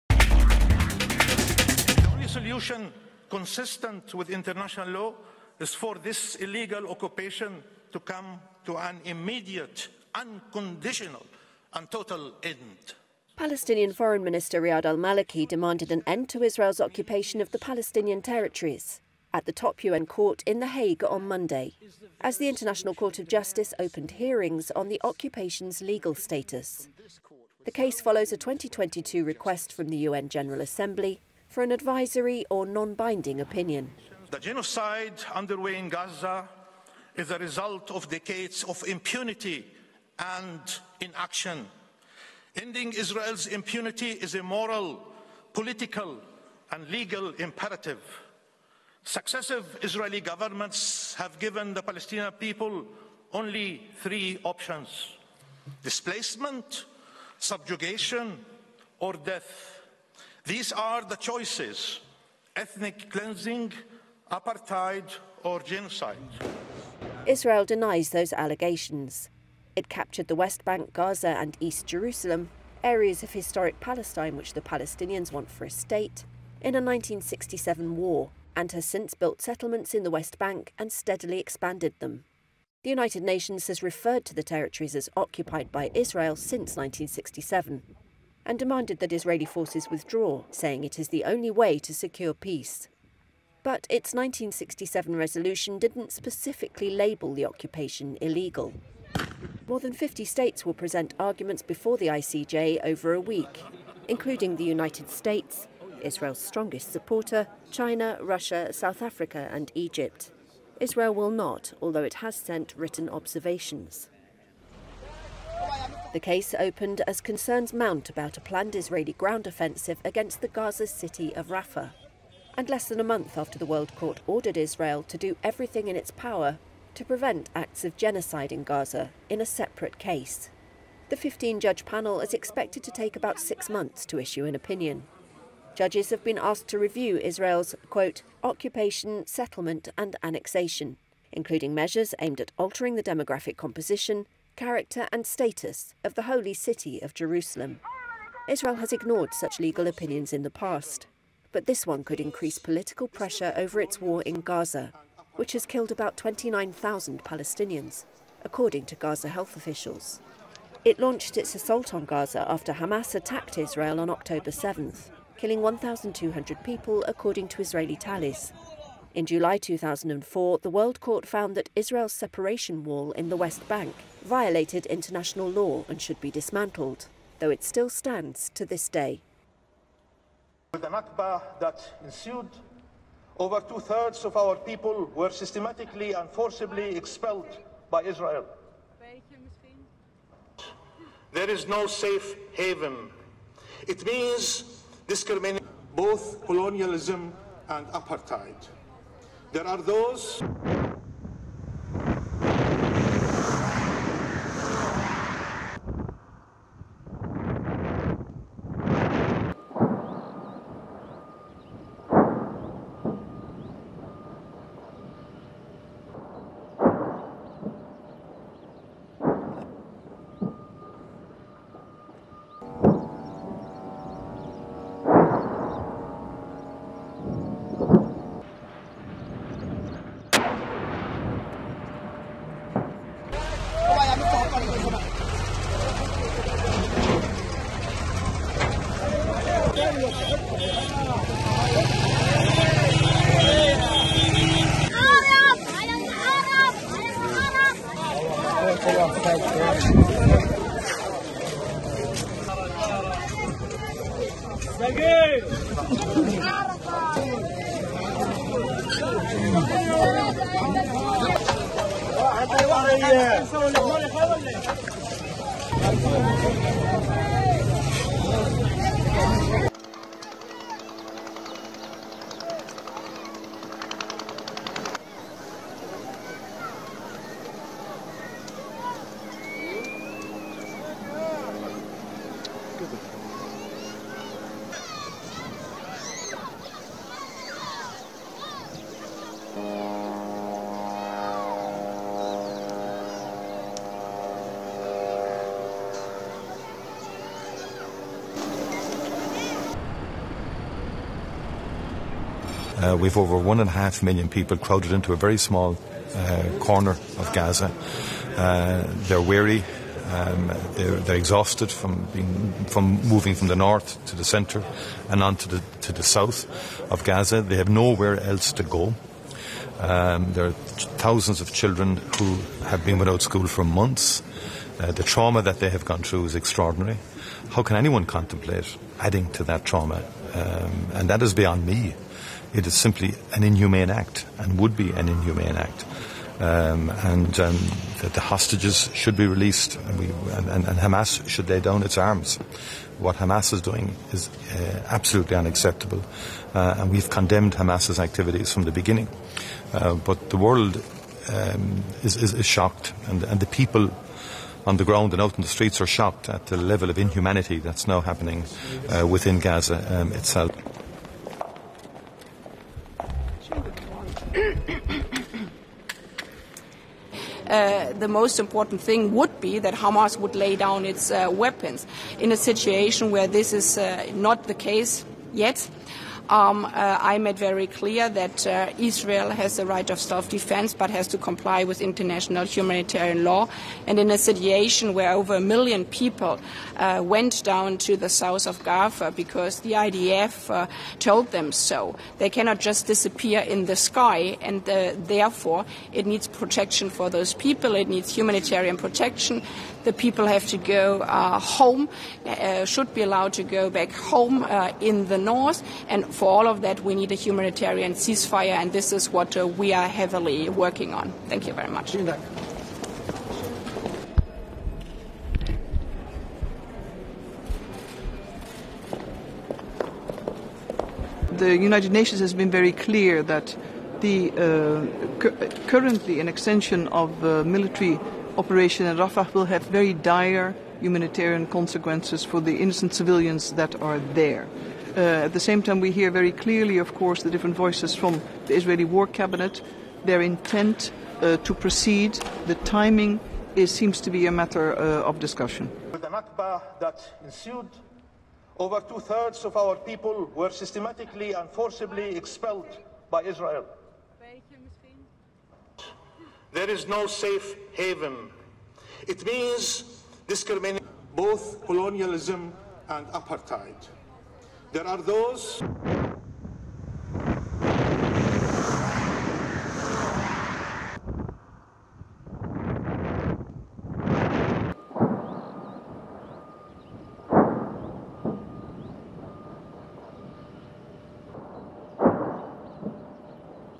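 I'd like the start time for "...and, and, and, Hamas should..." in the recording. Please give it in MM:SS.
05:40.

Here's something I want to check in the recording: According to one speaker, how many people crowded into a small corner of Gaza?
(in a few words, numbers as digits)
Over 1.5 million.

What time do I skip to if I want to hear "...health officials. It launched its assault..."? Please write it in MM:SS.
02:39.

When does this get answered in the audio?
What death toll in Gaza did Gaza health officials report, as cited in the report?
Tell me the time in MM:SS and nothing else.
02:35.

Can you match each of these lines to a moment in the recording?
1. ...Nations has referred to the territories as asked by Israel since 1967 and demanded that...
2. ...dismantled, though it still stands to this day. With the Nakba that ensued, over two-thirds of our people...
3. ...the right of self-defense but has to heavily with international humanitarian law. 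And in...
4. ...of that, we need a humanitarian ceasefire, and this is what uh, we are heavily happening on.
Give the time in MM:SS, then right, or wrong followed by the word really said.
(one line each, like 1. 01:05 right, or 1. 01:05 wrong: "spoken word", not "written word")
1. 01:23 wrong: "occupied", not "asked"
2. 02:56 right
3. 06:19 wrong: "comply", not "heavily"
4. 06:46 wrong: "working", not "happening".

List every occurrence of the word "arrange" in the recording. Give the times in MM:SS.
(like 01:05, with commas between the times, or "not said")
not said.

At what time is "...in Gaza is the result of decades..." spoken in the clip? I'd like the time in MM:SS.
00:35.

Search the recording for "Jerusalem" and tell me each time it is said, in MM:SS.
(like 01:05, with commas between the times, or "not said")
01:11, 02:27.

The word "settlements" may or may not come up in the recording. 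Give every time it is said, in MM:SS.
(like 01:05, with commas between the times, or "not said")
01:19, 02:19.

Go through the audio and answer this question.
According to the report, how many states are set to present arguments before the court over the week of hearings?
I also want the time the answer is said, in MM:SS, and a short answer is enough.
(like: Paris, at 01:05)
More than 50, at 01:39.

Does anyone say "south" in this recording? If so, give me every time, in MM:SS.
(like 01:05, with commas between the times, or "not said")
01:48, 05:16, 06:28.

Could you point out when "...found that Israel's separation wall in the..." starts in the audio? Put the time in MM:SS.
02:51.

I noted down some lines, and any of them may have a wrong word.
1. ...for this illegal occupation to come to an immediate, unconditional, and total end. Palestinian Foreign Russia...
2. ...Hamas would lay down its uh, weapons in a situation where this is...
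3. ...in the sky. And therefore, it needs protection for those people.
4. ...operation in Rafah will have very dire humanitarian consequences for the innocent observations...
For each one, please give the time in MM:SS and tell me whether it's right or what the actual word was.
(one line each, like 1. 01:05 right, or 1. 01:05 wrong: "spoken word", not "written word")
1. 00:05 wrong: "Minister", not "Russia"
2. 06:09 right
3. 06:33 right
4. 07:08 wrong: "civilians", not "observations".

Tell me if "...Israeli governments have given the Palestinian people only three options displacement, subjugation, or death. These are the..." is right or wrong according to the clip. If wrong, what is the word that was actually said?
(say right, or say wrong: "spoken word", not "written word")
right.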